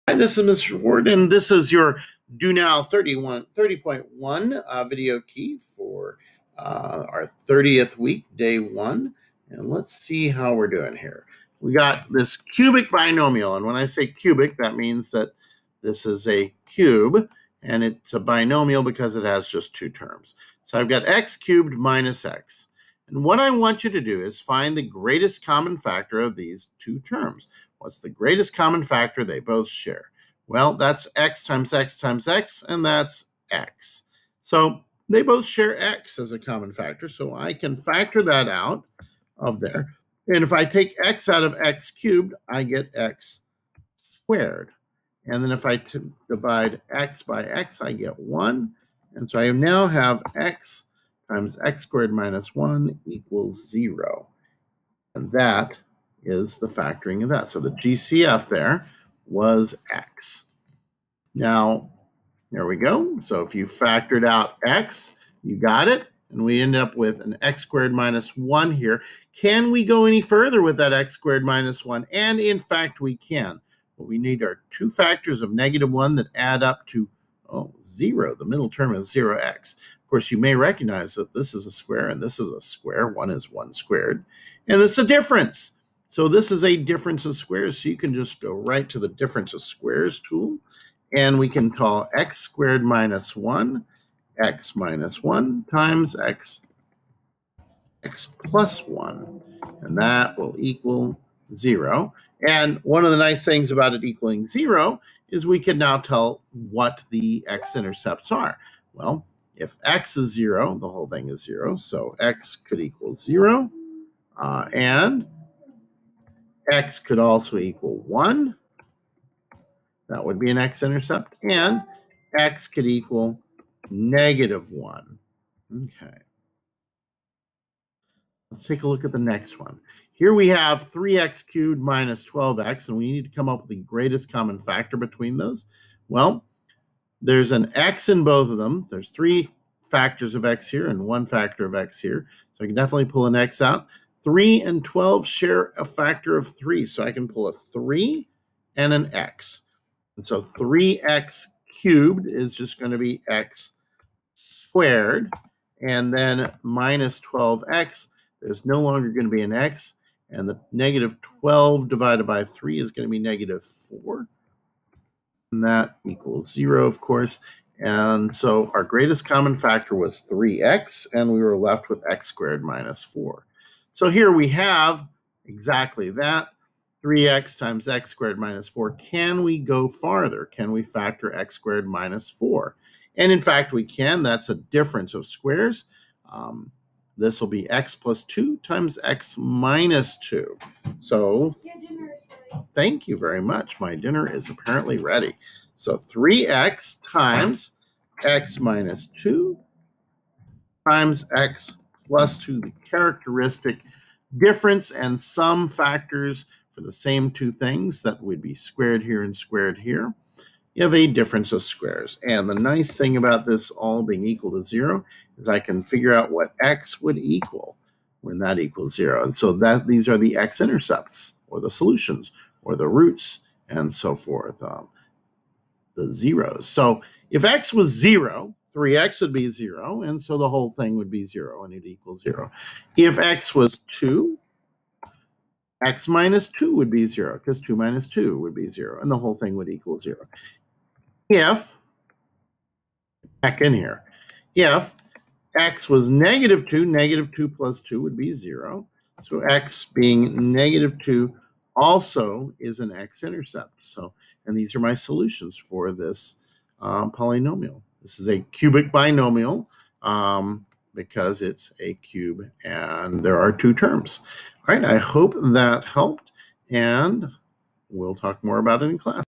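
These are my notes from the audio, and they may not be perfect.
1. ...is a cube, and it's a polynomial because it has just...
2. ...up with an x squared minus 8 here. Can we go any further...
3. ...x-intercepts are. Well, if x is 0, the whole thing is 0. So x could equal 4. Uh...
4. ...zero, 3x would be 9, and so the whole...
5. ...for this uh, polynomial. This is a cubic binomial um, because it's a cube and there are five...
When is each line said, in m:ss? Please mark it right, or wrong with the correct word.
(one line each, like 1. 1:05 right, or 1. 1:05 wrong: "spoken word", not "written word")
1. 0:16 wrong: "binomial", not "polynomial"
2. 1:06 wrong: "1", not "8"
3. 1:47 wrong: "0", not "4"
4. 3:47 wrong: "0", not "9"
5. 4:15 wrong: "two", not "five".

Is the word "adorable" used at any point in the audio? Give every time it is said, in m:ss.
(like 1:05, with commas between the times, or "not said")
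not said.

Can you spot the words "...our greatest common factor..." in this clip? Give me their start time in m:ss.
2:48.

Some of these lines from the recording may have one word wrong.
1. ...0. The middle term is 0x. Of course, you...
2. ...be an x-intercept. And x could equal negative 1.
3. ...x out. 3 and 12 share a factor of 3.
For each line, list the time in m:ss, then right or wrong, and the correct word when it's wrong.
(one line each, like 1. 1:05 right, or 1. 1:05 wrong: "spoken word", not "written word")
1. 1:17 right
2. 2:00 right
3. 2:23 right.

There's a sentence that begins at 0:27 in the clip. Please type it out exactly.
What's the greatest common factor they both share?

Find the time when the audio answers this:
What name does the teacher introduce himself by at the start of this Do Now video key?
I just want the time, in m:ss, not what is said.
0:00.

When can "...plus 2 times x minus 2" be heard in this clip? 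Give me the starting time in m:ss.
3:07.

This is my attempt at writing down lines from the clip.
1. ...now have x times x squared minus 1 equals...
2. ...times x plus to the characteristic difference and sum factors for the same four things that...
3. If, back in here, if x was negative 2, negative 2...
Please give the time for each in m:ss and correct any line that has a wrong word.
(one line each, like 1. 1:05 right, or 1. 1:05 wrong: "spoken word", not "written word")
1. 0:49 right
2. 3:20 wrong: "two", not "four"
3. 4:01 right.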